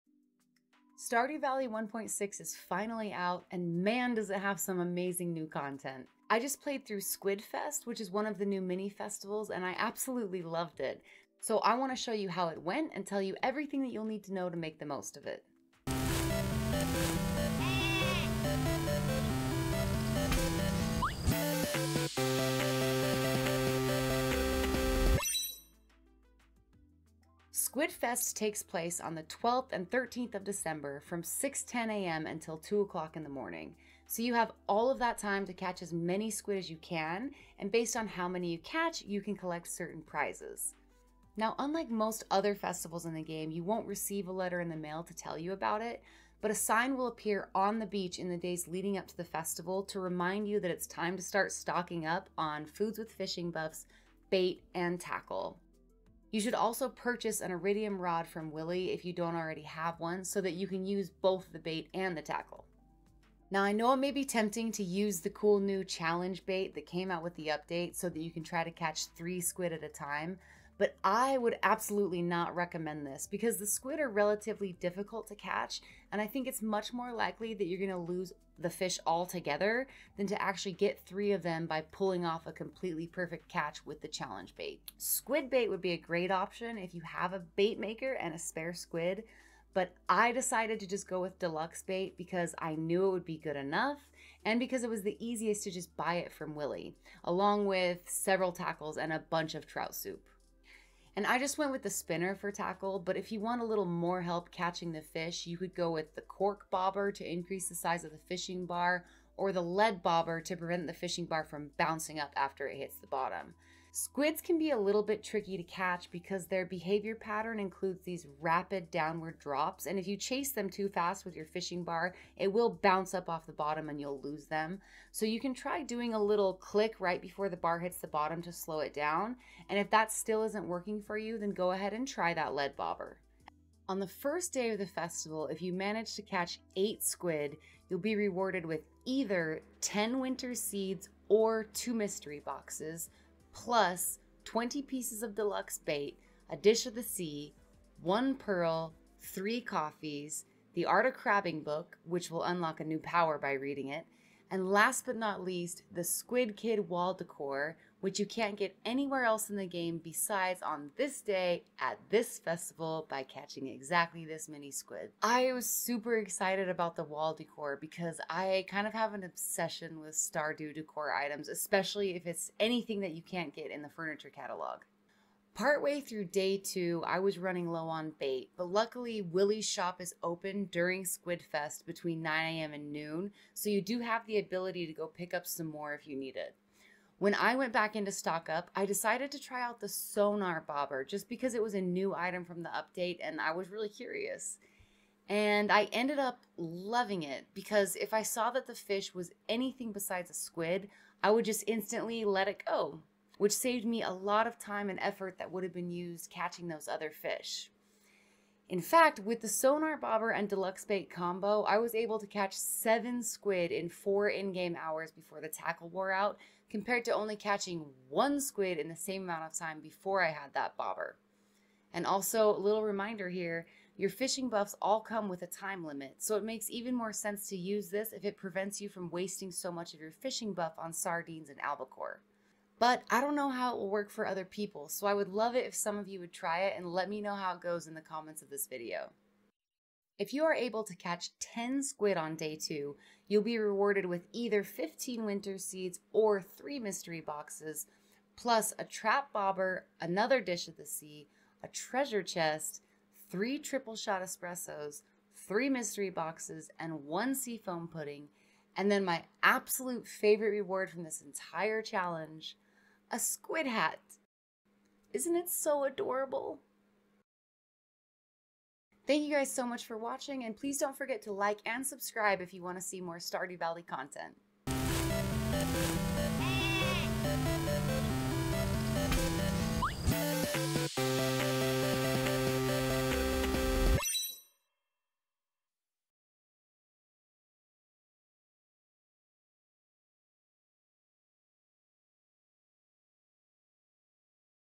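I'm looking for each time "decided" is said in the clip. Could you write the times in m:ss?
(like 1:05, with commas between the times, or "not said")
1:30, 3:08.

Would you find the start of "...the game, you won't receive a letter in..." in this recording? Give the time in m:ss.
0:43.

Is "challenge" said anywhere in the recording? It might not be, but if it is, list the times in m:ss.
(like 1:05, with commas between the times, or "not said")
1:05, 1:24, 4:21.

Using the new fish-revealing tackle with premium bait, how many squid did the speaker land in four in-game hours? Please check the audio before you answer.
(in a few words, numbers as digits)
7.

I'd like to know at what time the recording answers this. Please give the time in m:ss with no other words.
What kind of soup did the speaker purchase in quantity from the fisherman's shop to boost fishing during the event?
1:39.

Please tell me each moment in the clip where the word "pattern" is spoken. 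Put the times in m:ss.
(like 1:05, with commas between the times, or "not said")
1:57.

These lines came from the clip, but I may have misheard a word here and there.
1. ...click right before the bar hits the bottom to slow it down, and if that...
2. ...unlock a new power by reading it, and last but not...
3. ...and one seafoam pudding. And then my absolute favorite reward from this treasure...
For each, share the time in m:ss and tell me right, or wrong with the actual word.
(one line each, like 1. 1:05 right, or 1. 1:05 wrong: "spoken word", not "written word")
1. 2:06 right
2. 2:32 right
3. 4:16 wrong: "entire", not "treasure".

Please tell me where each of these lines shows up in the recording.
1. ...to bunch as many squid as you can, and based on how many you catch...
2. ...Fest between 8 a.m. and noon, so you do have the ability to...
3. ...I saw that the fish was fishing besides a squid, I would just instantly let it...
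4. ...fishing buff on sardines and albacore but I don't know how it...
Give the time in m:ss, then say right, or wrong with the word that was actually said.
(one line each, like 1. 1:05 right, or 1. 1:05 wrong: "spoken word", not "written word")
1. 0:35 wrong: "catch", not "bunch"
2. 3:01 wrong: "9", not "8"
3. 3:18 wrong: "anything", not "fishing"
4. 3:50 right.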